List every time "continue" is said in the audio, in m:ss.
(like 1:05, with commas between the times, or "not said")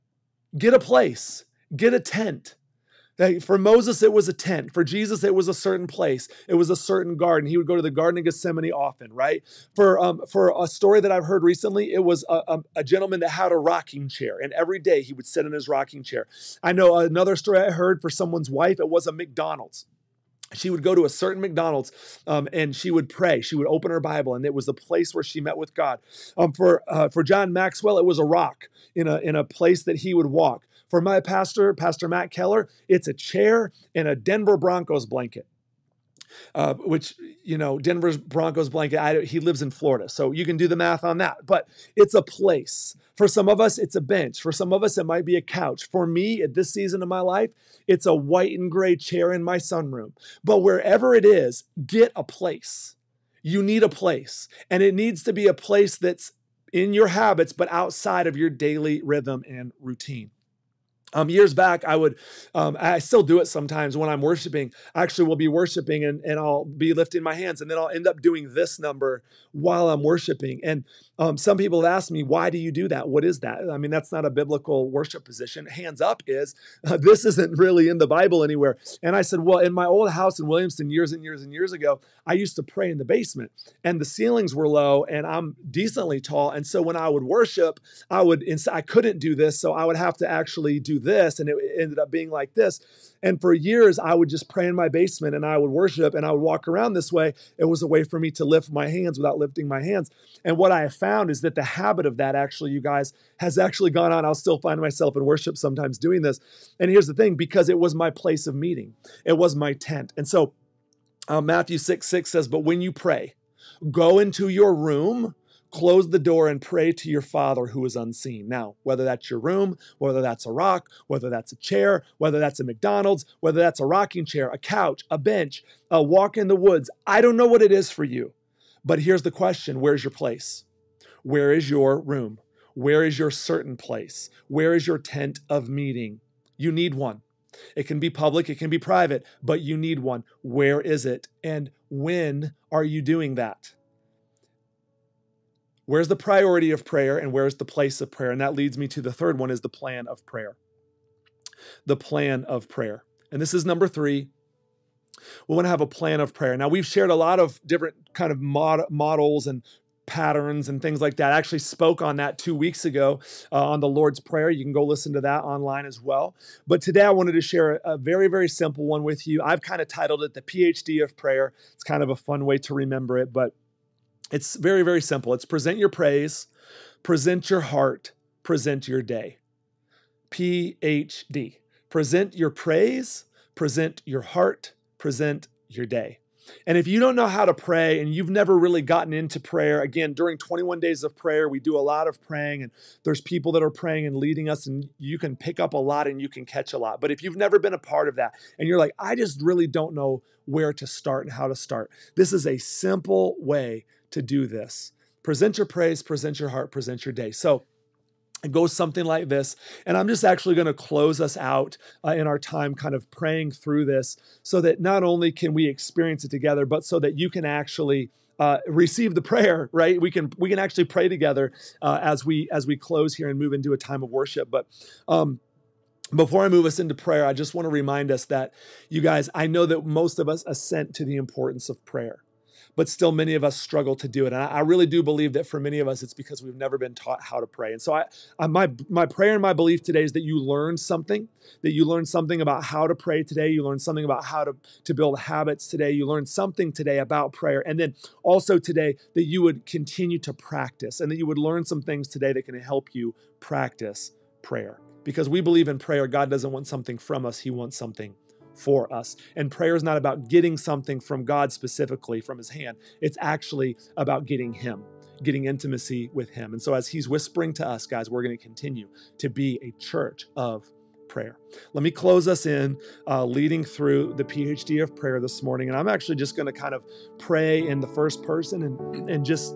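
4:09, 4:28.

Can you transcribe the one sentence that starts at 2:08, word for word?
But here's the question where's your place?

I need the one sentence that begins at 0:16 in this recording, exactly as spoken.
I know another story I heard for someone's wife.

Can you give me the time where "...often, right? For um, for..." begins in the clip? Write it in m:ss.
0:08.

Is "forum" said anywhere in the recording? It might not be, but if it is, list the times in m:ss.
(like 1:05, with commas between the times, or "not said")
not said.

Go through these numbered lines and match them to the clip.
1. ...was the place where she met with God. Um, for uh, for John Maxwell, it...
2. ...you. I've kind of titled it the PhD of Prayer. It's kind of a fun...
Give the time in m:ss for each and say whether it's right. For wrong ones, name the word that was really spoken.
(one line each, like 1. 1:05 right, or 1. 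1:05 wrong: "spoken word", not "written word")
1. 0:24 right
2. 2:49 right.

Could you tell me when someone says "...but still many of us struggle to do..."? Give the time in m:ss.
3:52.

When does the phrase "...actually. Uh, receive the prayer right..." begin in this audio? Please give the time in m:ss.
3:37.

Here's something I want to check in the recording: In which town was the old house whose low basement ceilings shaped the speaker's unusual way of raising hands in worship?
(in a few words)
Williamson.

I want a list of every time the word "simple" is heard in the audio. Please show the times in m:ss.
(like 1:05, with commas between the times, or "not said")
2:48, 2:55, 3:22.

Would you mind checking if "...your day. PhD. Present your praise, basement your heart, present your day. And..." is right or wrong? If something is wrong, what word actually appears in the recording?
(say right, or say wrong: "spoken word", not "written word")
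wrong: "present", not "basement".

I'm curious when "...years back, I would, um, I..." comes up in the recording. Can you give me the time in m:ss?
1:01.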